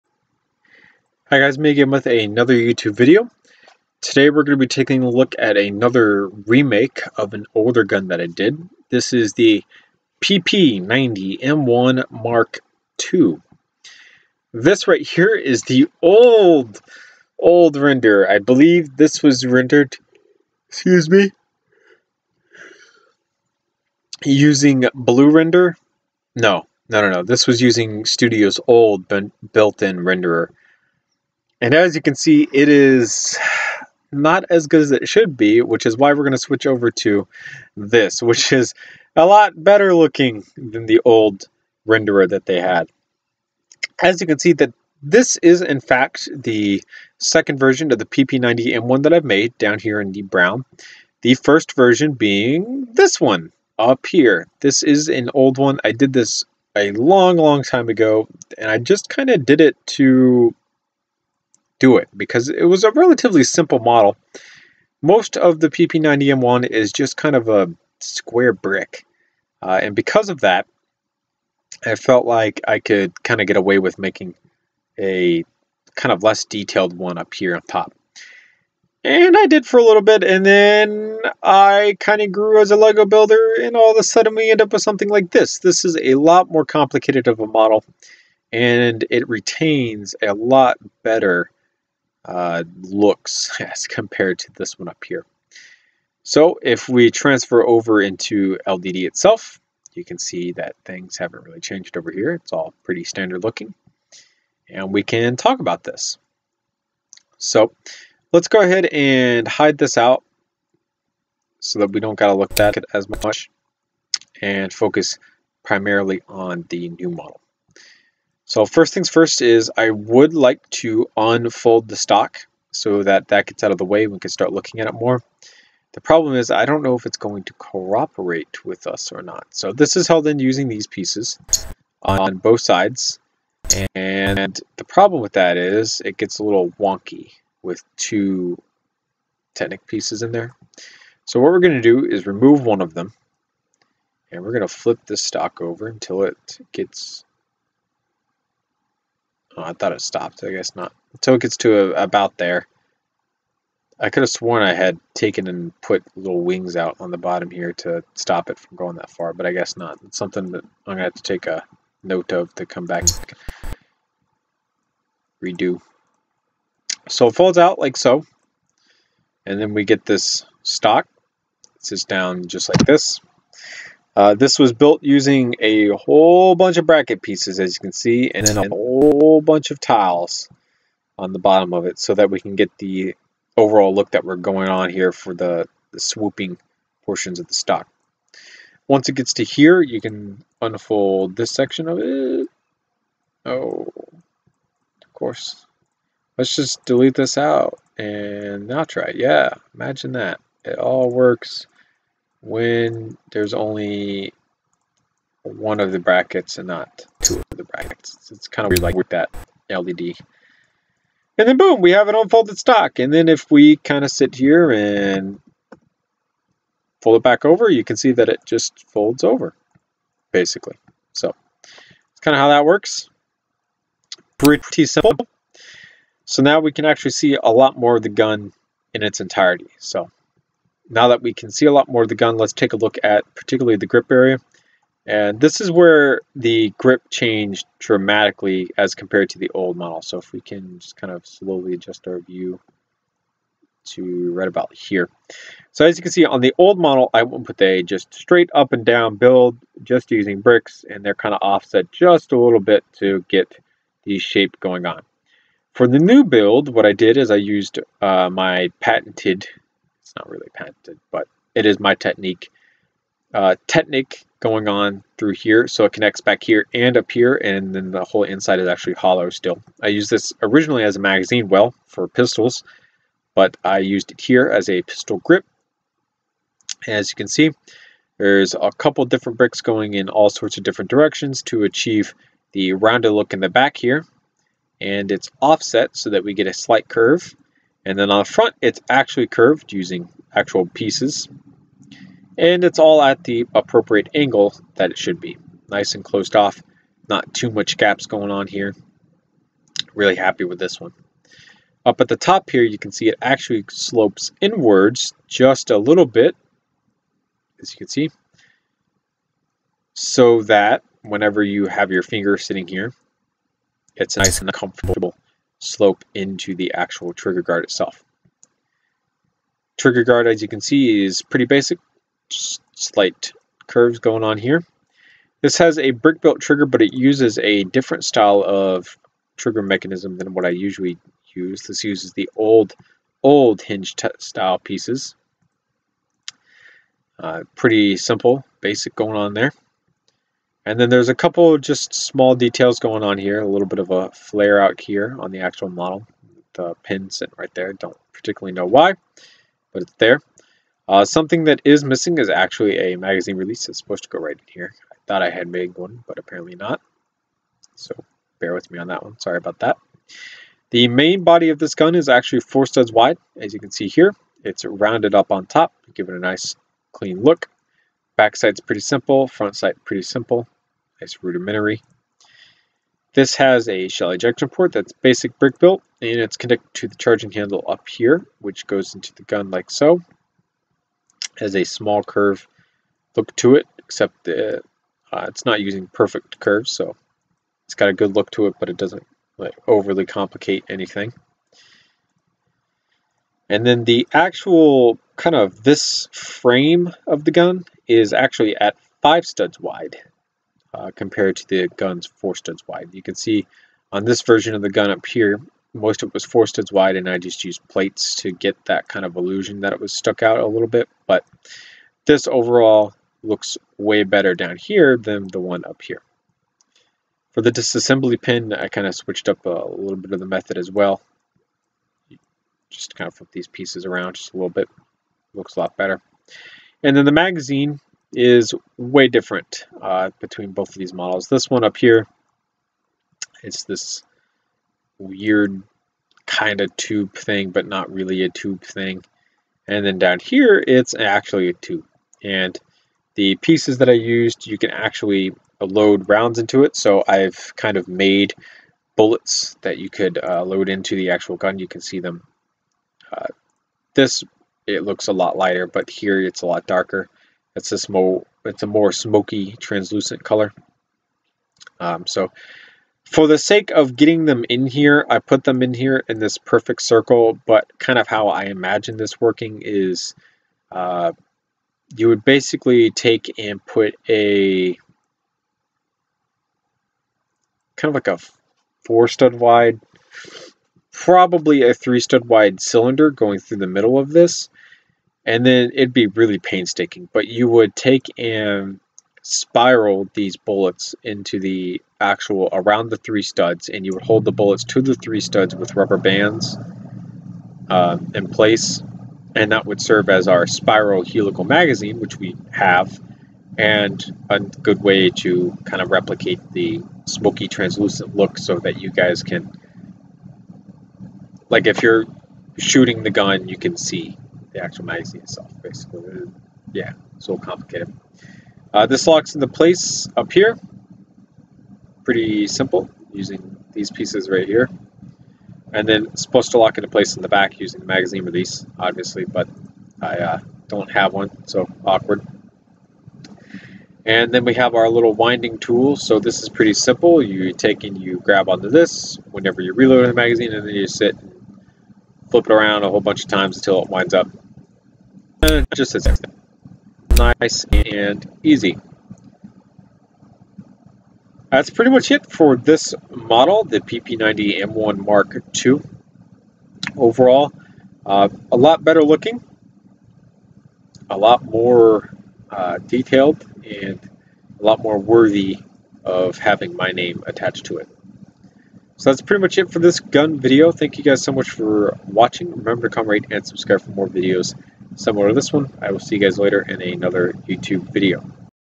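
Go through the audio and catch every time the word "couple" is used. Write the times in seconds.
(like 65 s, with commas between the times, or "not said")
278 s, 341 s.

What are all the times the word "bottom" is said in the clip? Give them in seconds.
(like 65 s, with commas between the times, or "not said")
157 s, 181 s.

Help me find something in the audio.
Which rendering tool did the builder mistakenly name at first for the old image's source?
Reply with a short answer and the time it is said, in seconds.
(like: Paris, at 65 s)
Blue Render, at 24 s.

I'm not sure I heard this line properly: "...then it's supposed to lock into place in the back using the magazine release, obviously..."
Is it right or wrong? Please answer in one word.
right.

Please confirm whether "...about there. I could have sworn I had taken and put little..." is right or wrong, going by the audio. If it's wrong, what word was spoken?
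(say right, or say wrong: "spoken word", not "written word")
right.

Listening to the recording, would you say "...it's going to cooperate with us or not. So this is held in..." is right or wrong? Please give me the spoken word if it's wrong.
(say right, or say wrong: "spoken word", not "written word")
right.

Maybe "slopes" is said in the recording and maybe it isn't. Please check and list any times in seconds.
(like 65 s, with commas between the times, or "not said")
303 s, 315 s.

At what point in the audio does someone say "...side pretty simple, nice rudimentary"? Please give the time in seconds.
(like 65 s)
369 s.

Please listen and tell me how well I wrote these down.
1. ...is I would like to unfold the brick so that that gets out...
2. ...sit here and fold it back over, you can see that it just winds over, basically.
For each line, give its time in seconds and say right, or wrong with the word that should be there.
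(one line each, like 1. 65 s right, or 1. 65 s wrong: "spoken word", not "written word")
1. 119 s wrong: "stock", not "brick"
2. 214 s wrong: "folds", not "winds".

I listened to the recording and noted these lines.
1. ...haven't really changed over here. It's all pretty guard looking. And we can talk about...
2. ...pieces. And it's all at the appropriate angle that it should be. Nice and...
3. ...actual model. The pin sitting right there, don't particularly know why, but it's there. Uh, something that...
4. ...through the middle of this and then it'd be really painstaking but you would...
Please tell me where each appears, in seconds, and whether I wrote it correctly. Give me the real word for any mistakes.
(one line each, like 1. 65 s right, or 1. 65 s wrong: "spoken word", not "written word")
1. 101 s wrong: "standard", not "guard"
2. 290 s right
3. 345 s right
4. 483 s right.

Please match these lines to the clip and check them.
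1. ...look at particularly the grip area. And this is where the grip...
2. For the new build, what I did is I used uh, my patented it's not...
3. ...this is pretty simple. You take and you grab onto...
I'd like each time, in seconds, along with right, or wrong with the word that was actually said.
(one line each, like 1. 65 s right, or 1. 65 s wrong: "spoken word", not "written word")
1. 232 s right
2. 255 s right
3. 536 s right.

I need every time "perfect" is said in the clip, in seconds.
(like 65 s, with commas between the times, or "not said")
385 s, 466 s.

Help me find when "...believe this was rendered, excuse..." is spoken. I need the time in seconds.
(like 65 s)
18 s.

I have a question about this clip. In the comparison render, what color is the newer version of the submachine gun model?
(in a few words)
brown.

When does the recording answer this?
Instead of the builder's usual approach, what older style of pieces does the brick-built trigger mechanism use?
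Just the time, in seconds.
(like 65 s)
333 s.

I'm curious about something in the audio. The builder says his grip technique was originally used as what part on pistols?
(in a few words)
magazine well.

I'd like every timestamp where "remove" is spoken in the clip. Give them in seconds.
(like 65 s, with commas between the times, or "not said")
142 s.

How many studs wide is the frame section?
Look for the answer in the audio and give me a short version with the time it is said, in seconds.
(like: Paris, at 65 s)
5, at 399 s.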